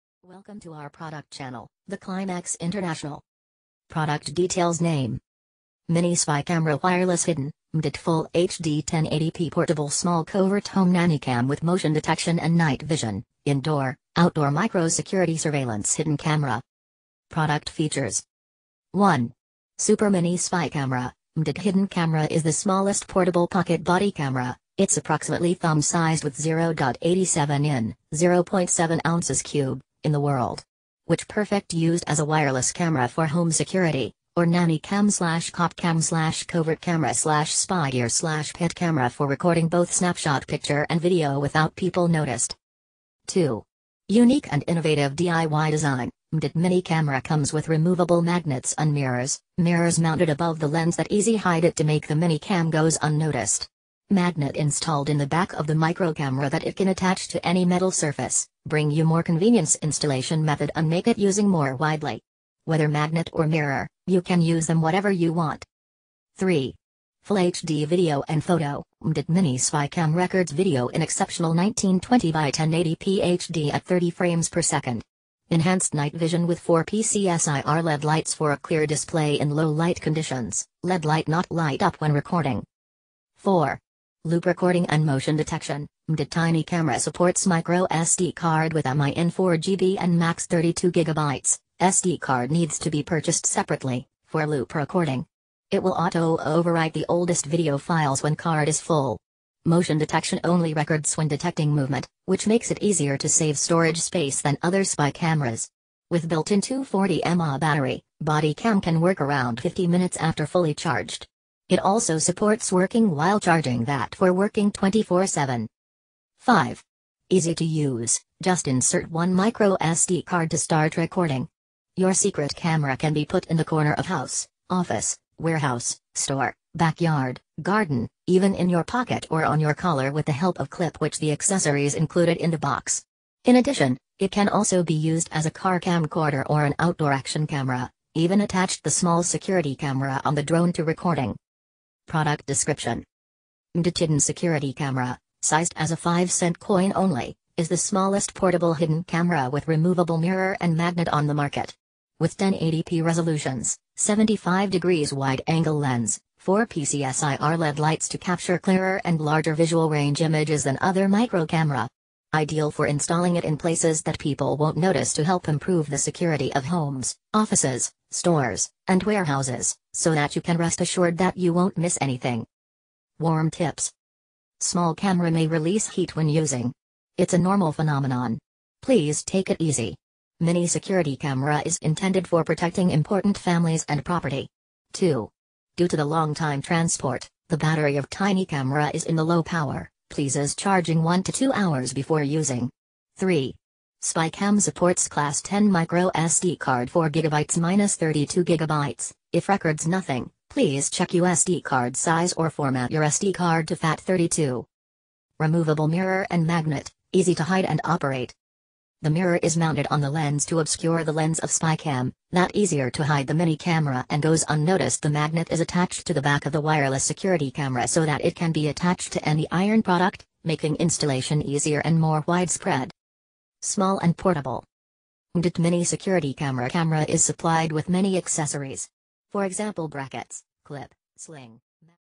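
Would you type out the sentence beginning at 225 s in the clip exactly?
MHDYT Mini Security Camera Camera is supplied with many accessories.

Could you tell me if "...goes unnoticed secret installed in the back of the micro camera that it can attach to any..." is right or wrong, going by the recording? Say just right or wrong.
wrong.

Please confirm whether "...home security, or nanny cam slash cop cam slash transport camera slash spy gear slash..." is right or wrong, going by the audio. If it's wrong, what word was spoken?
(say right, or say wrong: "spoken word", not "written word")
wrong: "covert", not "transport".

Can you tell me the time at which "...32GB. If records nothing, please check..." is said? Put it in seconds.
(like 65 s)
197 s.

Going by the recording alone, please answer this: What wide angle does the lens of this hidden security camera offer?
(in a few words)
75 degrees.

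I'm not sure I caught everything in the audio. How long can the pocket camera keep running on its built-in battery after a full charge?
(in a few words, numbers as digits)
50 minutes.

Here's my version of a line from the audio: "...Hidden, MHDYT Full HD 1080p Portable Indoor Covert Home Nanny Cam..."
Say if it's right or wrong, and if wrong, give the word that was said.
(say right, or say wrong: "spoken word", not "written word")
wrong: "Small", not "Indoor".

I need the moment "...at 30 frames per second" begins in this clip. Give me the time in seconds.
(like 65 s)
73 s.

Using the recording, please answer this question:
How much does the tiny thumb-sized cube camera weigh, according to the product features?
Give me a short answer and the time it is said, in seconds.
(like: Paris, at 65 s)
0.7 ounces, at 28 s.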